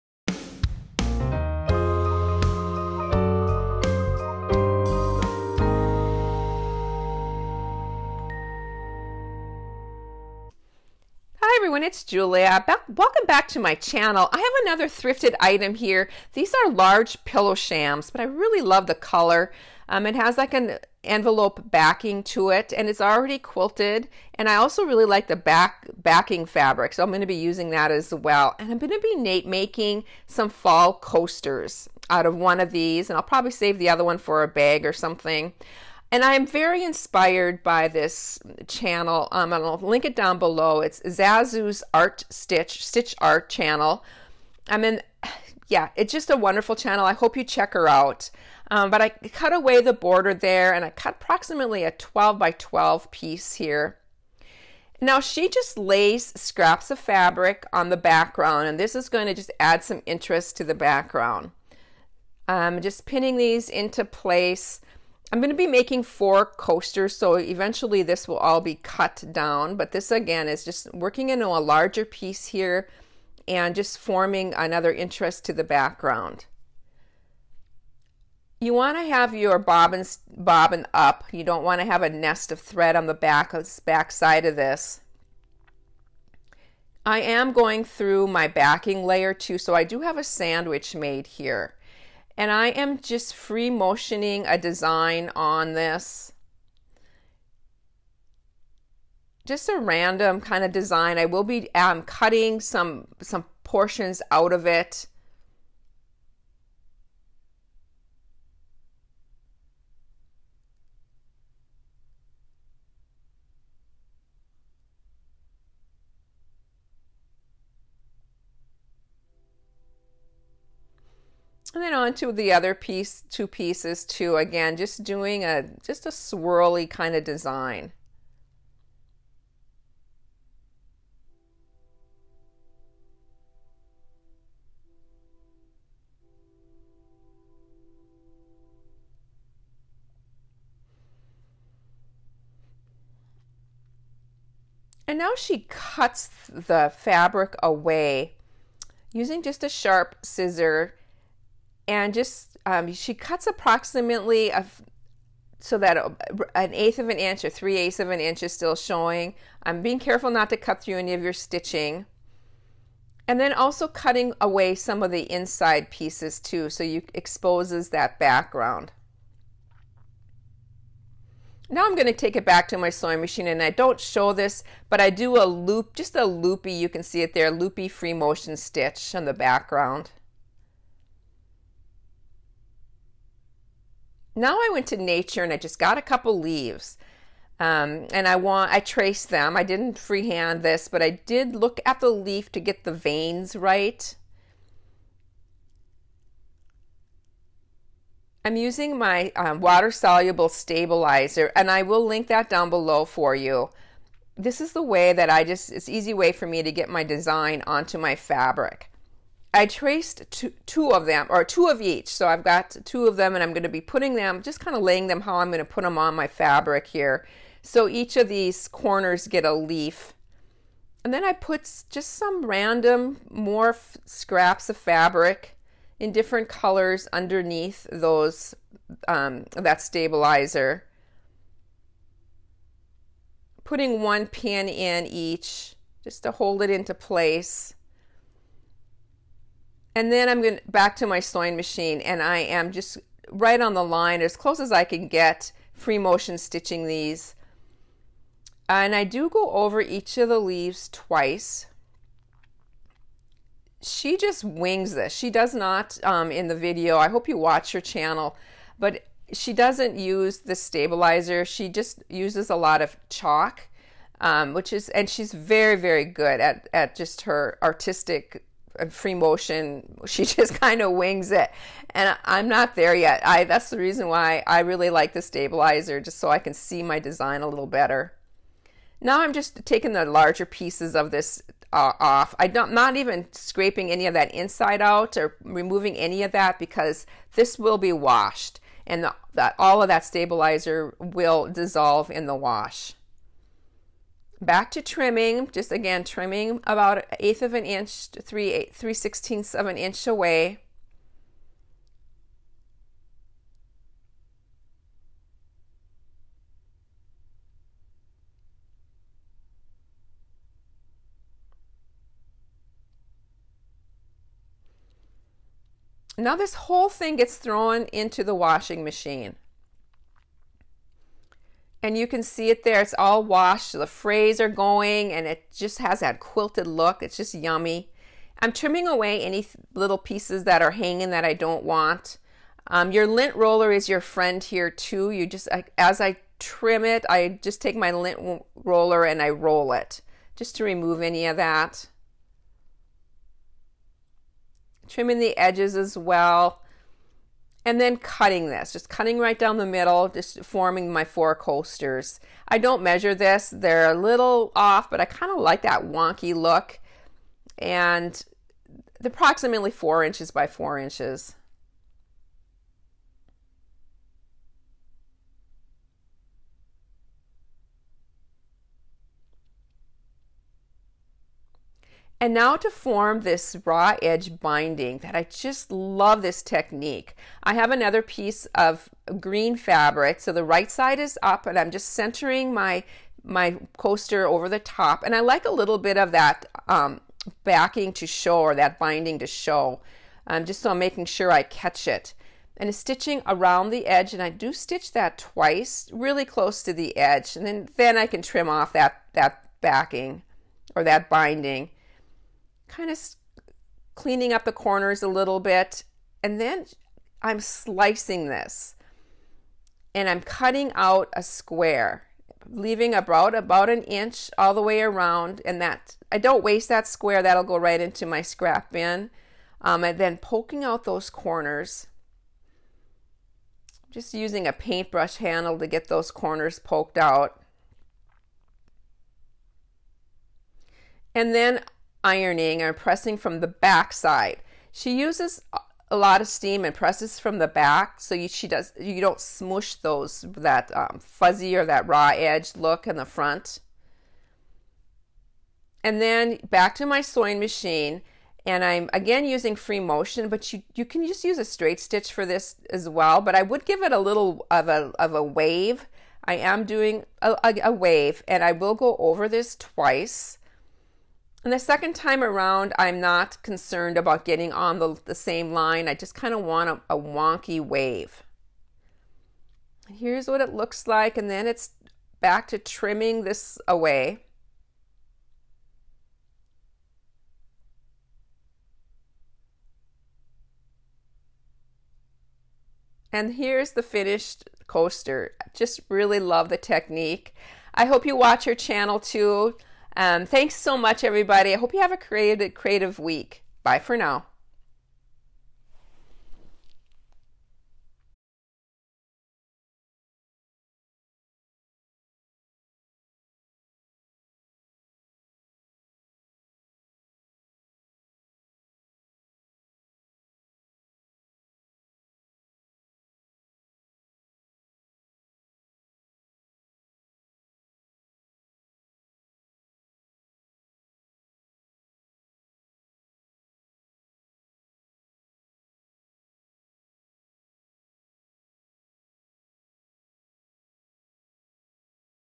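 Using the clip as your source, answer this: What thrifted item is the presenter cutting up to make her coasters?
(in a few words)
Large pillow shams.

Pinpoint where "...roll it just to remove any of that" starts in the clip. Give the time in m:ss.
5:39.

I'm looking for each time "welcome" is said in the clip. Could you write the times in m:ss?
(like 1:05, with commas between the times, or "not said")
0:12.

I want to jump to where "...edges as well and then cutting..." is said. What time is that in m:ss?
5:45.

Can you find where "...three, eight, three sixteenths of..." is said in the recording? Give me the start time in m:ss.
4:58.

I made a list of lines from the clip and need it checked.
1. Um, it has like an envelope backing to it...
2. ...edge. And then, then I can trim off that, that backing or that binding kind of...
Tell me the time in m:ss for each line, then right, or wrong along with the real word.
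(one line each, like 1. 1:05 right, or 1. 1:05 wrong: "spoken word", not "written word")
1. 0:19 right
2. 6:36 right.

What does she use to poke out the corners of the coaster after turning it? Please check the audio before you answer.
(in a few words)
A paintbrush handle.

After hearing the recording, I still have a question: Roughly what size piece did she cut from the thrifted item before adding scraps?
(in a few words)
12 by 12.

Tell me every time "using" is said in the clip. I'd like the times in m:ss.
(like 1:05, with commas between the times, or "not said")
0:27, 2:29, 3:18, 7:04, 7:29.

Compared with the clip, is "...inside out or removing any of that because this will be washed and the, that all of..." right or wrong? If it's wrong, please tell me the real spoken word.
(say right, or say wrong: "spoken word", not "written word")
right.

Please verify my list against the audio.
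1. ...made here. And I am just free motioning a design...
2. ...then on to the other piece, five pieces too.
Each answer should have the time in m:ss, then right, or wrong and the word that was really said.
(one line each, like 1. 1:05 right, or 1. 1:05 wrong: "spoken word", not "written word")
1. 1:30 right
2. 2:01 wrong: "two", not "five".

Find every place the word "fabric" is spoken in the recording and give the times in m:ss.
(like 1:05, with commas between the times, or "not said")
0:26, 0:56, 2:26, 3:28, 3:36, 3:44, 6:19.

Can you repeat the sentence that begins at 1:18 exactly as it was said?
You want to have your bobbin, bobbin up.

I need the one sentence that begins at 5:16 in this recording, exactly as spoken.
Now this whole thing gets thrown into the washing machine.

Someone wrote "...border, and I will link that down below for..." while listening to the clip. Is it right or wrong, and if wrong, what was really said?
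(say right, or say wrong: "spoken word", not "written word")
wrong: "stabilizer", not "border".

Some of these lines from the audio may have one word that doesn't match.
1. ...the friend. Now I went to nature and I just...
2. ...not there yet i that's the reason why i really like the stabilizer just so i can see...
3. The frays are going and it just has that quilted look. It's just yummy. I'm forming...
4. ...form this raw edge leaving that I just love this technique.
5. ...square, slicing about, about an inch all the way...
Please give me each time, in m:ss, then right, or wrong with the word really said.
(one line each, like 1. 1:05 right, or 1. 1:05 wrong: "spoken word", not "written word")
1. 2:59 wrong: "background", not "friend"
2. 4:32 right
3. 5:23 wrong: "trimming", not "forming"
4. 6:12 wrong: "binding", not "leaving"
5. 6:51 wrong: "leaving", not "slicing".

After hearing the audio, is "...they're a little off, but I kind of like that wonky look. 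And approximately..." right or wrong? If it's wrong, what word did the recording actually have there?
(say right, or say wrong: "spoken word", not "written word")
right.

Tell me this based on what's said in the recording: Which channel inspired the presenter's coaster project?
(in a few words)
Zazu's Art Stitch.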